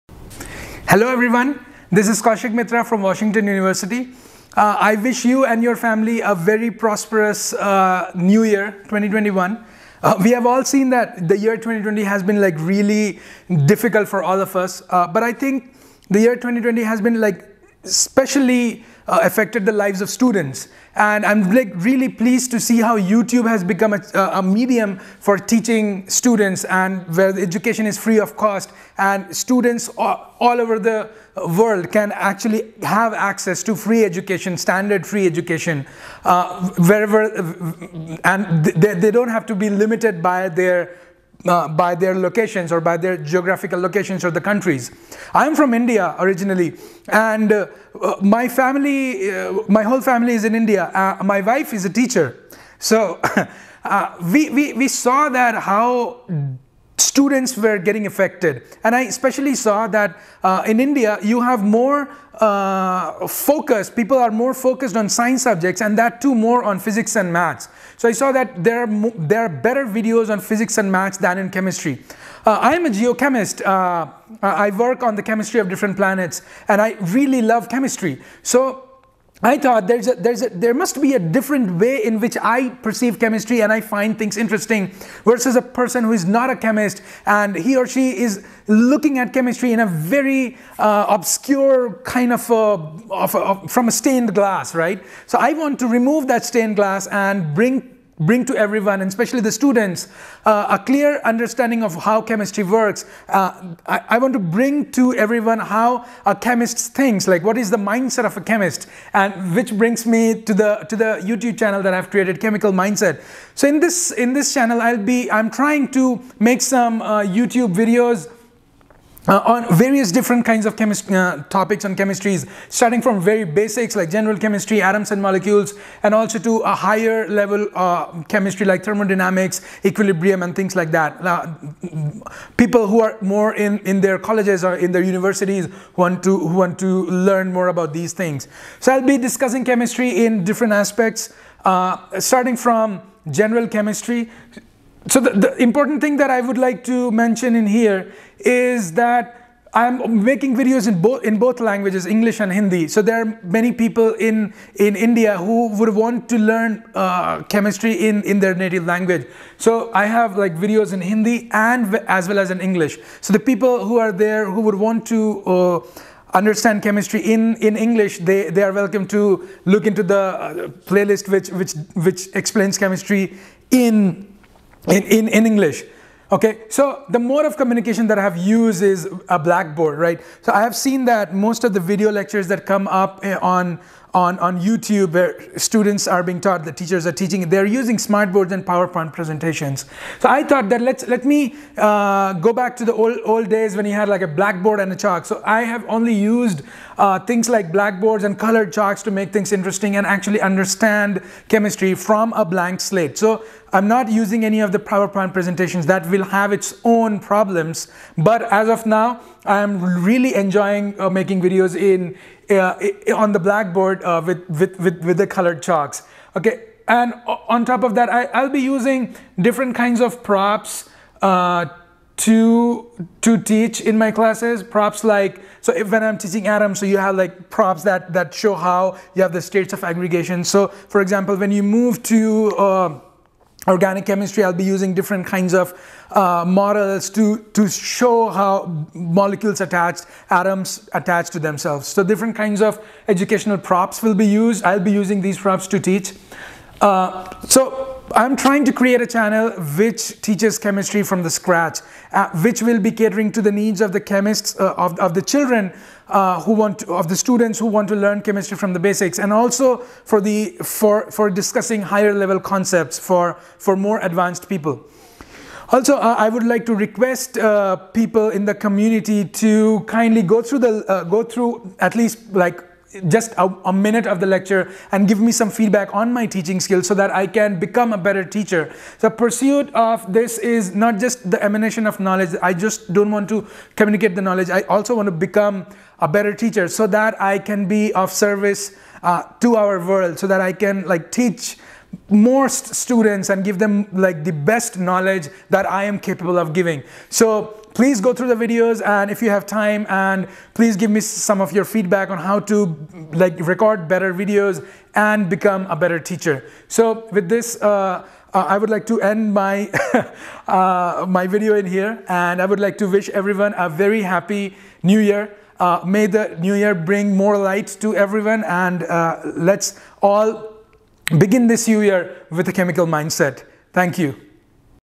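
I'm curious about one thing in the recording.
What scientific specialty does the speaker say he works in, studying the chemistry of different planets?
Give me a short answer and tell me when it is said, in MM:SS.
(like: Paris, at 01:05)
Geochemist, at 01:12.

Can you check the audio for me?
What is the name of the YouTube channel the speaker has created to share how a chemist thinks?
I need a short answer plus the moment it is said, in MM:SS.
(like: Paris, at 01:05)
KMical Mindset, at 01:52.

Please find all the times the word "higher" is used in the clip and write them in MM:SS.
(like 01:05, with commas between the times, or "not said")
02:06, 04:21.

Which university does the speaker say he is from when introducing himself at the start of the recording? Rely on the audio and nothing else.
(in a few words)
Washington University.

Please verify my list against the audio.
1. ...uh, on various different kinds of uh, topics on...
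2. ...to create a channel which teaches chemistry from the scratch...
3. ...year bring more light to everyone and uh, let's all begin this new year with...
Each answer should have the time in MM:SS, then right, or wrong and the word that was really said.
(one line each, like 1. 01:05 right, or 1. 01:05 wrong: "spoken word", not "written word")
1. 01:59 right
2. 04:08 right
3. 05:16 right.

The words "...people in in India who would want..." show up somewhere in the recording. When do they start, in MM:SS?
02:33.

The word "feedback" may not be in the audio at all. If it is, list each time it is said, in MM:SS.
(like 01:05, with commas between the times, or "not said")
04:35, 05:01.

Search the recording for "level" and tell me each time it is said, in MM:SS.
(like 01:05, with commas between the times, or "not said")
02:07, 04:22.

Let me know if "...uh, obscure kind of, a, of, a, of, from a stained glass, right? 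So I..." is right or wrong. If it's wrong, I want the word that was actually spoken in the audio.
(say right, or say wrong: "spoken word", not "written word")
right.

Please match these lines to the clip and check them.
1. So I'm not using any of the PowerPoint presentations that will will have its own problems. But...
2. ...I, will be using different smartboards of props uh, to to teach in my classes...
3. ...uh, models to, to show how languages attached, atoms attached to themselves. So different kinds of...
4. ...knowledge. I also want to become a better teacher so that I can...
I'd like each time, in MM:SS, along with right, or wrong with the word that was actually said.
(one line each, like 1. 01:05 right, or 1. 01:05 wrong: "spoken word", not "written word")
1. 03:23 right
2. 03:38 wrong: "kinds", not "smartboards"
3. 03:56 wrong: "molecules", not "languages"
4. 04:44 right.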